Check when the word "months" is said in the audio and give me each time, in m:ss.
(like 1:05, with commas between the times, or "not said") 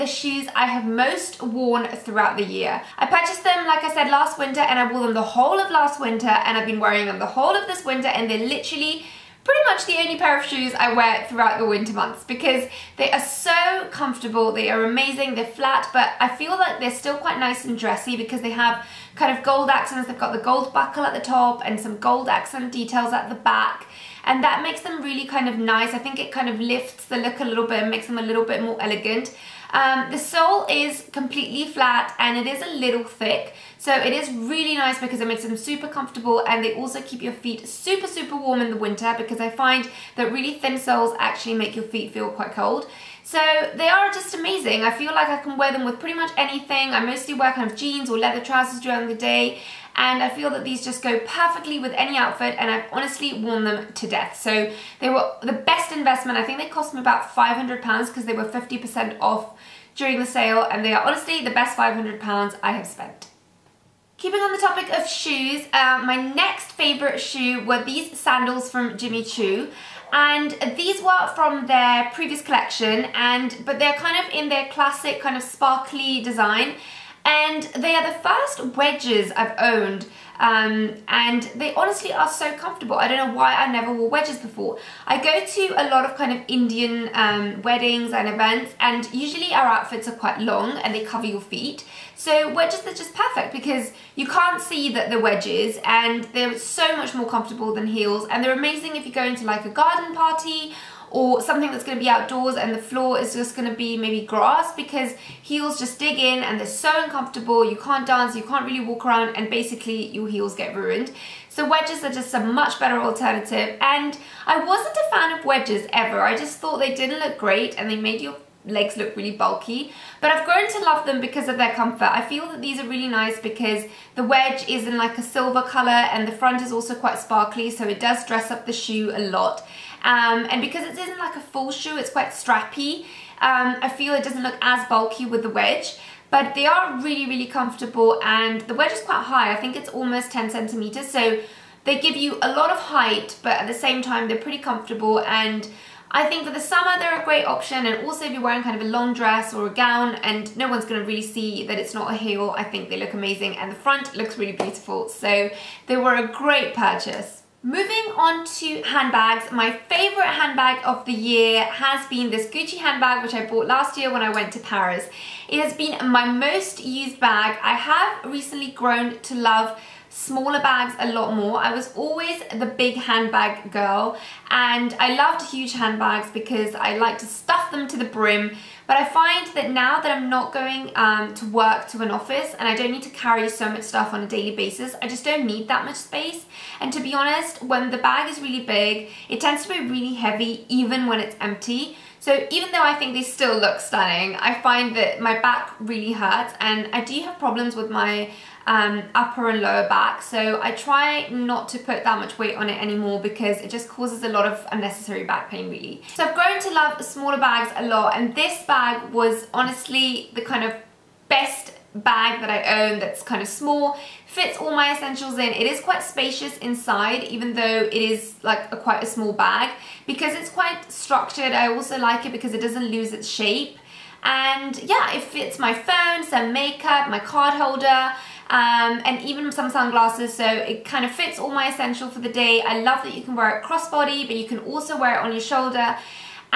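0:11.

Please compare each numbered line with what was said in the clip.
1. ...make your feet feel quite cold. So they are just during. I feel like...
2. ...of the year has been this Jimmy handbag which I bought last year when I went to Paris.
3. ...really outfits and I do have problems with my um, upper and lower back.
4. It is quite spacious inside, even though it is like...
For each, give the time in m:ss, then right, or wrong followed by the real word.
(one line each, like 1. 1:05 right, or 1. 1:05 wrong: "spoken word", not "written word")
1. 0:41 wrong: "amazing", not "during"
2. 2:40 wrong: "Gucci", not "Jimmy"
3. 3:15 wrong: "hurts", not "outfits"
4. 3:35 right.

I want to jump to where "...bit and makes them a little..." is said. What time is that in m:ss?
0:27.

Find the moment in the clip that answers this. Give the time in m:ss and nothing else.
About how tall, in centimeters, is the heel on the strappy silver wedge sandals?
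2:20.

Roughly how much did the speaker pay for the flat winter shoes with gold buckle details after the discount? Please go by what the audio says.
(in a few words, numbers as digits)
500 pounds.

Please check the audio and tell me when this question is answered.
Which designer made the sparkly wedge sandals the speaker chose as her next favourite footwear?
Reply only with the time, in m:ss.
1:08.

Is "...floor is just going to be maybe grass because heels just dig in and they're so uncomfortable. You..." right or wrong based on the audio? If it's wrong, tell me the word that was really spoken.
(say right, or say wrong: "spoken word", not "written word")
right.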